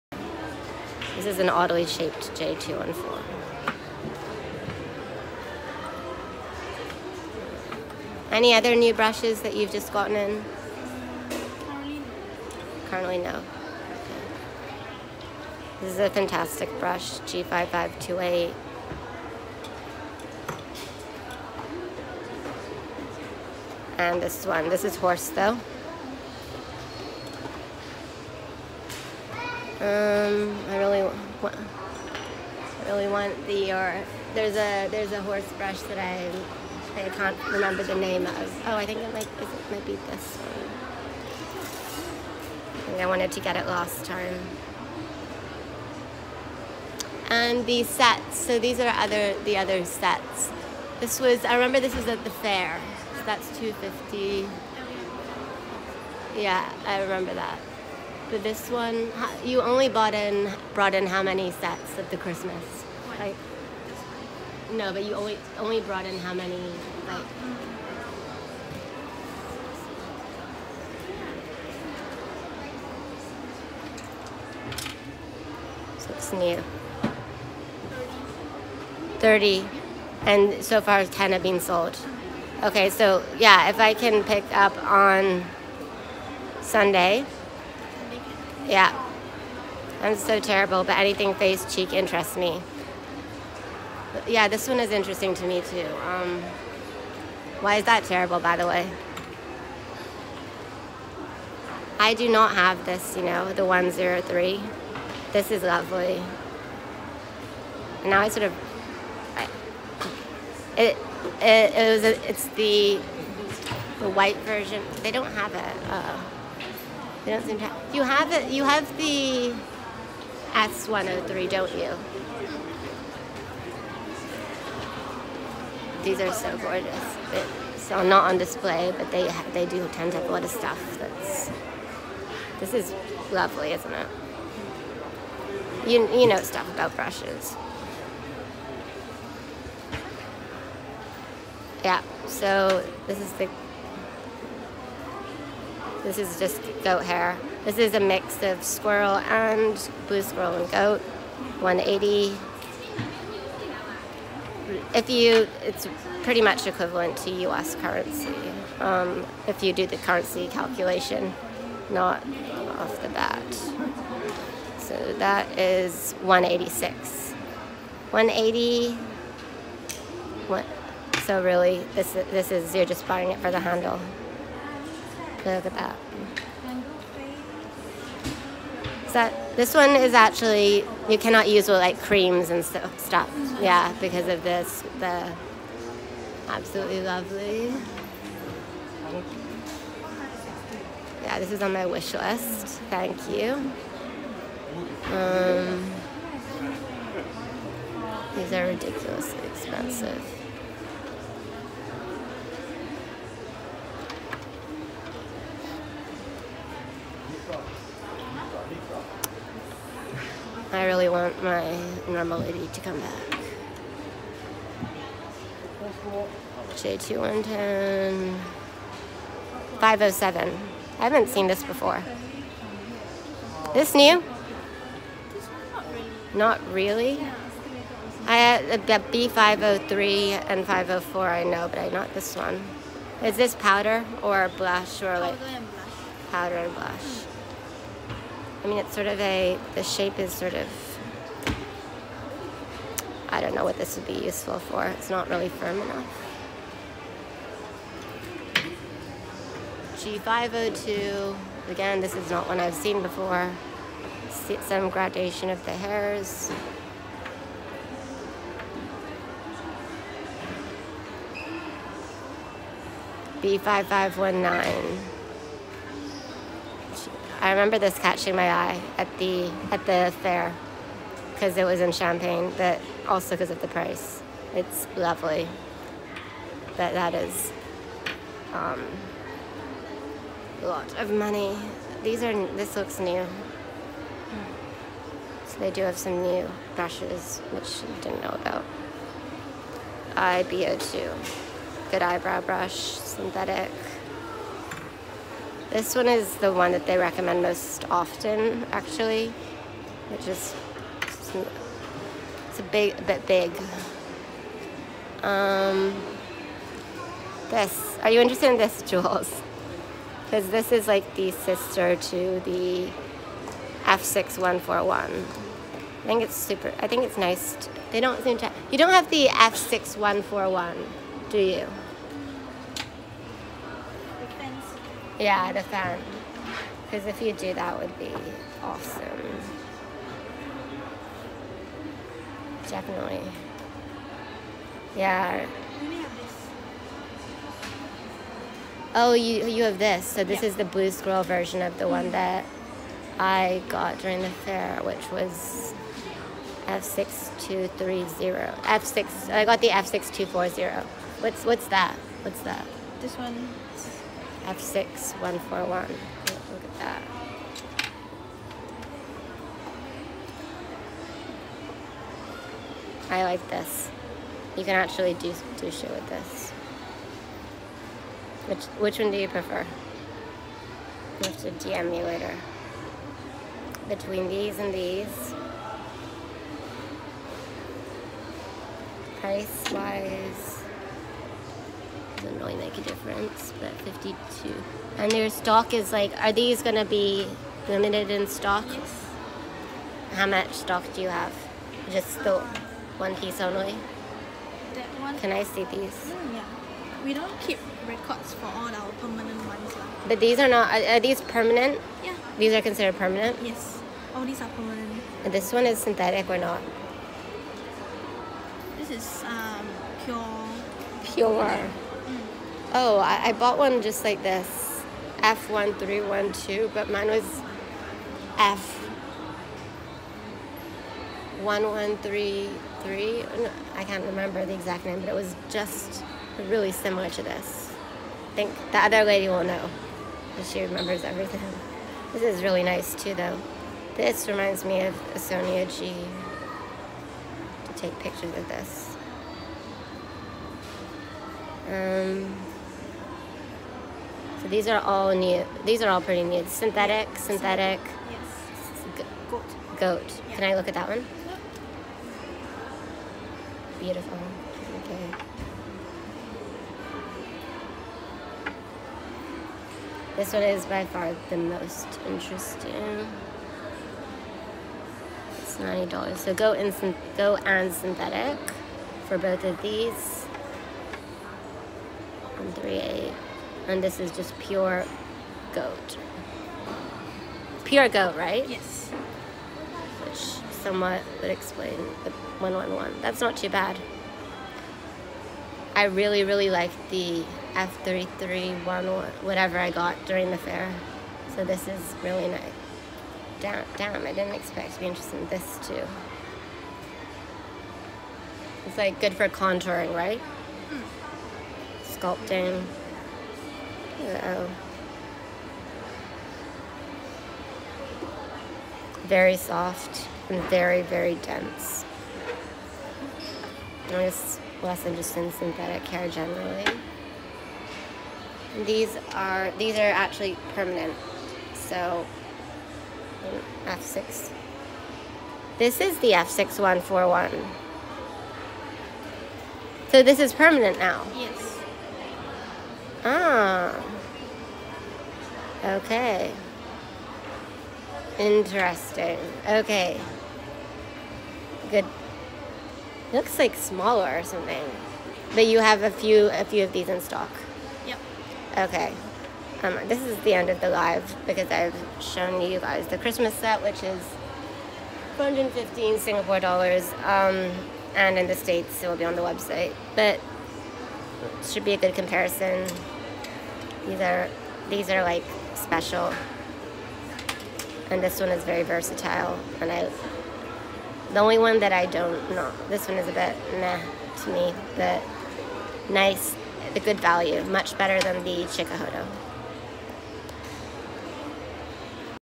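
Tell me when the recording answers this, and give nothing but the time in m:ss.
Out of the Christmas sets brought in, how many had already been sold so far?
1:21.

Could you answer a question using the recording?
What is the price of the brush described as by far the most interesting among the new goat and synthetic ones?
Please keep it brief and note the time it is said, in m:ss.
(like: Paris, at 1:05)
$90, at 7:45.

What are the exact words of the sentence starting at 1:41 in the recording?
I do not have this, you know, the 103.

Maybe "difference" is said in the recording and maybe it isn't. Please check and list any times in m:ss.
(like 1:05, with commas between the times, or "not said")
6:22.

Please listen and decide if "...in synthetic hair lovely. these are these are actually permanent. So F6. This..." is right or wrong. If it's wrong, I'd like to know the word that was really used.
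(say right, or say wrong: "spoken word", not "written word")
wrong: "generally", not "lovely".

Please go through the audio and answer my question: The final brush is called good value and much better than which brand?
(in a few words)
Chikuhodo.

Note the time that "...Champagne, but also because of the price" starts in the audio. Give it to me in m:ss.
4:31.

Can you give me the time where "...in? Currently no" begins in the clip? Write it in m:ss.
0:10.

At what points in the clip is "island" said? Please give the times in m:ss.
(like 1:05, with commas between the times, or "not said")
not said.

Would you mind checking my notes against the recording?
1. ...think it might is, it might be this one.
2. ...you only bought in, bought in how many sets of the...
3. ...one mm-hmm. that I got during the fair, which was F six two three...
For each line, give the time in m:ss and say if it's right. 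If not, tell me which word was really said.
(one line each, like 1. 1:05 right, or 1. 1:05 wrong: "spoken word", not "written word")
1. 0:38 right
2. 0:59 wrong: "brought", not "bought"
3. 5:41 right.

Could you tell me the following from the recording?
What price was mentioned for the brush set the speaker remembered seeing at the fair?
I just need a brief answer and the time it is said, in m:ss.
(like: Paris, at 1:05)
250, at 0:53.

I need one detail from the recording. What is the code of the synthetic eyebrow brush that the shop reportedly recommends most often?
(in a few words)
IBO2.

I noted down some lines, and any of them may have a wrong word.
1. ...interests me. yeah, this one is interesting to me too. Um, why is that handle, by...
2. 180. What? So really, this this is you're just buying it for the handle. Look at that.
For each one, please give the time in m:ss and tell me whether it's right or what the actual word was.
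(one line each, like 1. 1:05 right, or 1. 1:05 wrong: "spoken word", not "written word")
1. 1:31 wrong: "terrible", not "handle"
2. 2:48 right.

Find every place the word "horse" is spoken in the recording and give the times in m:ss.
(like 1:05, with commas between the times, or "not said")
0:24, 0:35.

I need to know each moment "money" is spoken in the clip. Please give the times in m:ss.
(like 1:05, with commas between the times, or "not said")
4:41.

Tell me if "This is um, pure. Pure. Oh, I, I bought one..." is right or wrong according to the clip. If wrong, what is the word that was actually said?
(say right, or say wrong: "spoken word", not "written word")
right.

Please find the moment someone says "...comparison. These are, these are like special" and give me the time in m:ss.
9:21.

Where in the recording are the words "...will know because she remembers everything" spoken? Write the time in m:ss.
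7:09.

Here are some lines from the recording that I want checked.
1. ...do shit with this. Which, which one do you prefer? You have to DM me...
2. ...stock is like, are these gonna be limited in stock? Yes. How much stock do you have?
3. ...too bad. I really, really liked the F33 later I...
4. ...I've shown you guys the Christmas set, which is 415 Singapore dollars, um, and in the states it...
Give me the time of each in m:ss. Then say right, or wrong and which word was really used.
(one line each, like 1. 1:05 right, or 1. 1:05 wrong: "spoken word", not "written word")
1. 6:05 right
2. 6:25 right
3. 8:03 wrong: "whatever", not "later"
4. 9:11 right.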